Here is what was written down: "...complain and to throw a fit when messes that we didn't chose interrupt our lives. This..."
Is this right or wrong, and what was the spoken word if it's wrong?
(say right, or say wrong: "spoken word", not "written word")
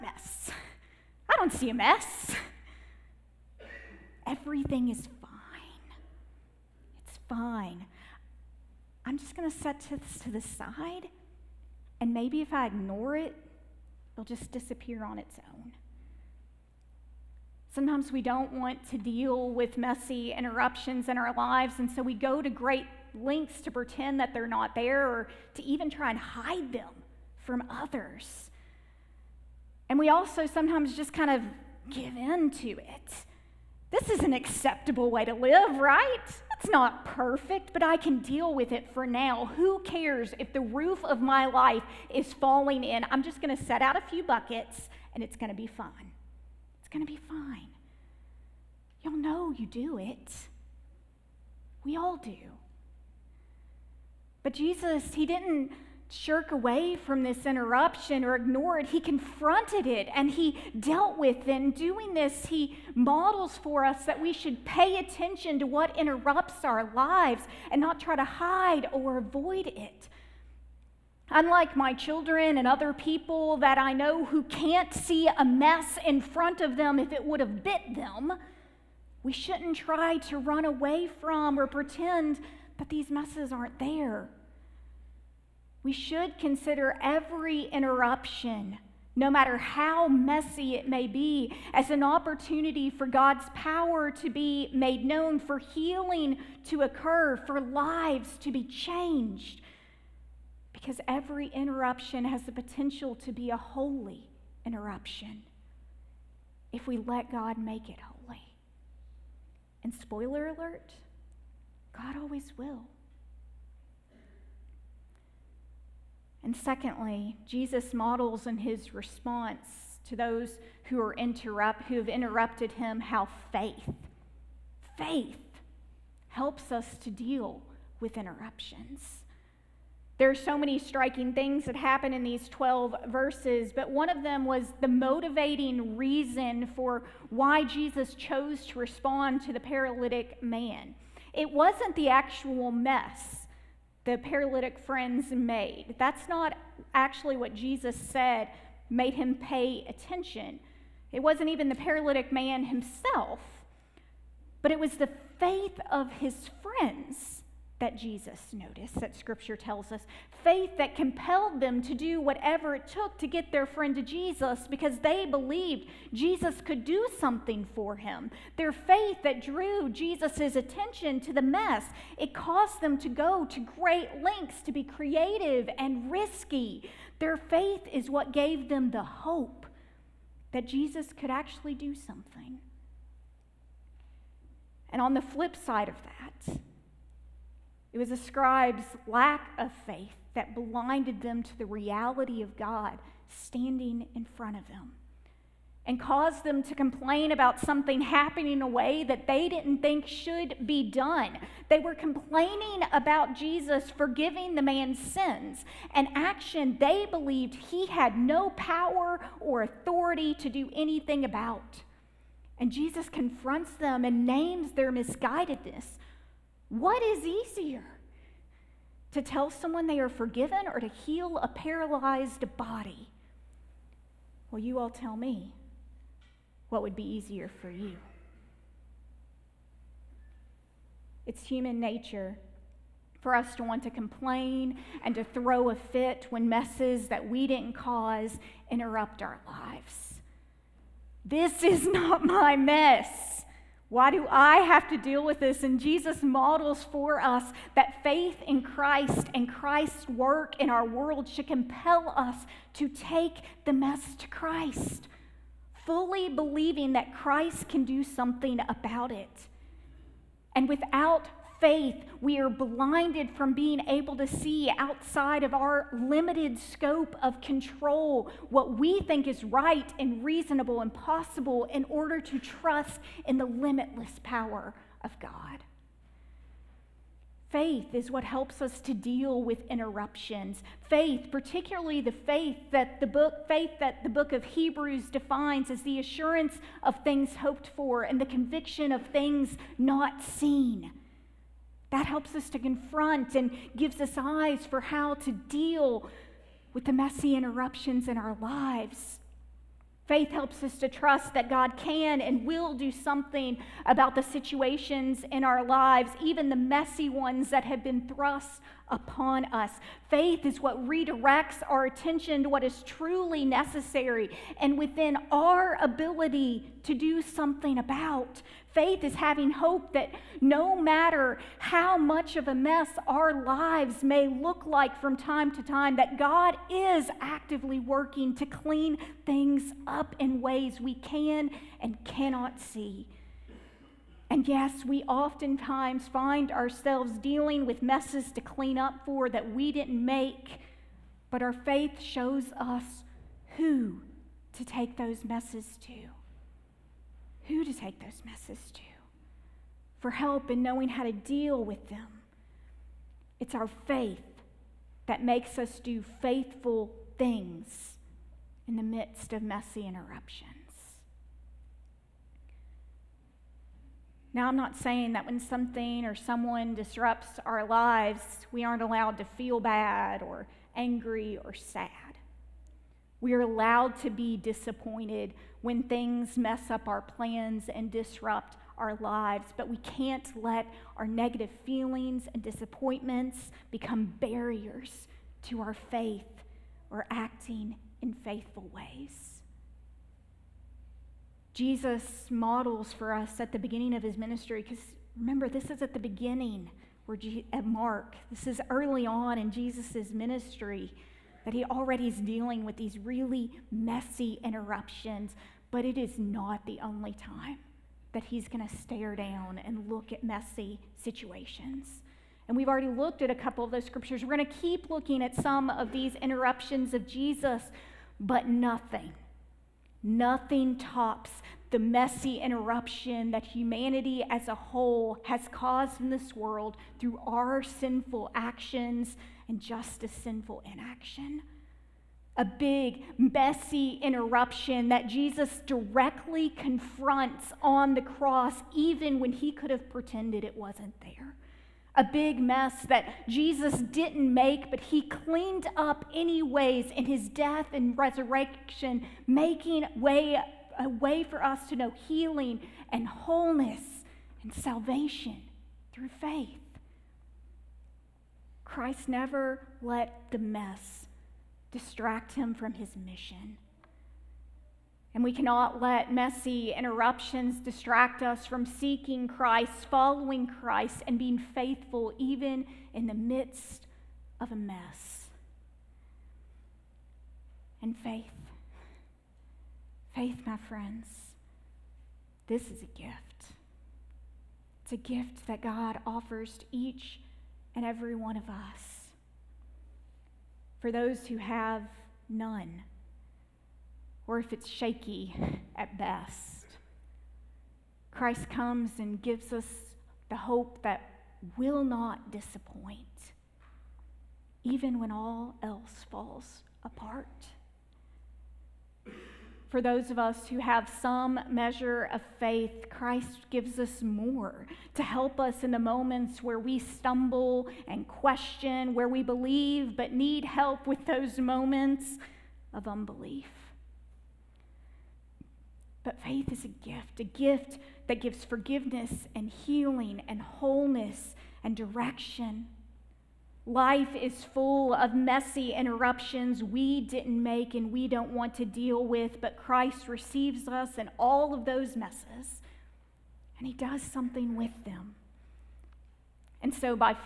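wrong: "cause", not "chose".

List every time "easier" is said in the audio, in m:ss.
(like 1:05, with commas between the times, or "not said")
3:37, 3:47.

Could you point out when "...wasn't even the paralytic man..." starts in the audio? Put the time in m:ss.
2:31.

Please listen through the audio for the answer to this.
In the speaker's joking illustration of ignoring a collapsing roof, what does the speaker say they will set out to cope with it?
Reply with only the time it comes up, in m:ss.
0:43.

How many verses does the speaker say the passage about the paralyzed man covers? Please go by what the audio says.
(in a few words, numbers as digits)
12.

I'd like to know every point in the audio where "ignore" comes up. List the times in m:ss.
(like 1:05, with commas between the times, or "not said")
0:12, 0:58.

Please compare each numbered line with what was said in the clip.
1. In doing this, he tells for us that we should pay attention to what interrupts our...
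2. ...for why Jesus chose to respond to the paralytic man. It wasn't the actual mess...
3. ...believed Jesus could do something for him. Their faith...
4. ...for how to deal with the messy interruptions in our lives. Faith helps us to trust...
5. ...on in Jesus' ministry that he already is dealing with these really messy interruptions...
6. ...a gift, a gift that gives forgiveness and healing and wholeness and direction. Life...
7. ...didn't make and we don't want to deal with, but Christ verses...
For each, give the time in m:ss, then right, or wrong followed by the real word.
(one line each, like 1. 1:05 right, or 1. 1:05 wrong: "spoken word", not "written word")
1. 1:01 wrong: "models", not "tells"
2. 2:16 right
3. 2:45 right
4. 4:54 right
5. 6:39 right
6. 8:46 right
7. 8:57 wrong: "receives", not "verses".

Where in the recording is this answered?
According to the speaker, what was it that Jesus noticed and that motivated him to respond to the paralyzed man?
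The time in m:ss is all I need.
2:35.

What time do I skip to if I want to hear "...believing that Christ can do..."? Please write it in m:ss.
4:16.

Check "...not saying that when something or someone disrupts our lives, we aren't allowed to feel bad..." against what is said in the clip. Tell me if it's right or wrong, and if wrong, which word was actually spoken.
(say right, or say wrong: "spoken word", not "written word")
right.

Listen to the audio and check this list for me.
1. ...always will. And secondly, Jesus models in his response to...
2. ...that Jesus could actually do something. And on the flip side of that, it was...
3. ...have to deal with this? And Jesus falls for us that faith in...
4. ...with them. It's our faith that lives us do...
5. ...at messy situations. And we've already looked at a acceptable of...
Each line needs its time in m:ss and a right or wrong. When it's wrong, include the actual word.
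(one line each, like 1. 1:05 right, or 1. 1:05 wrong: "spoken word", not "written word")
1. 1:52 right
2. 3:00 right
3. 4:04 wrong: "models", not "falls"
4. 5:51 wrong: "makes", not "lives"
5. 6:50 wrong: "couple", not "acceptable".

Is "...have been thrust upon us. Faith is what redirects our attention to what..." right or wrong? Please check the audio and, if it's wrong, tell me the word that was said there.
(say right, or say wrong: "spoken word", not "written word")
right.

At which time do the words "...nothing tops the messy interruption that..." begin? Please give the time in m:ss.
7:00.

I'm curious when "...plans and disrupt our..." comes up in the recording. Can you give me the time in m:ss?
6:17.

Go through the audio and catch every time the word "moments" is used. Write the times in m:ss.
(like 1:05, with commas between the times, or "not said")
8:35, 8:41.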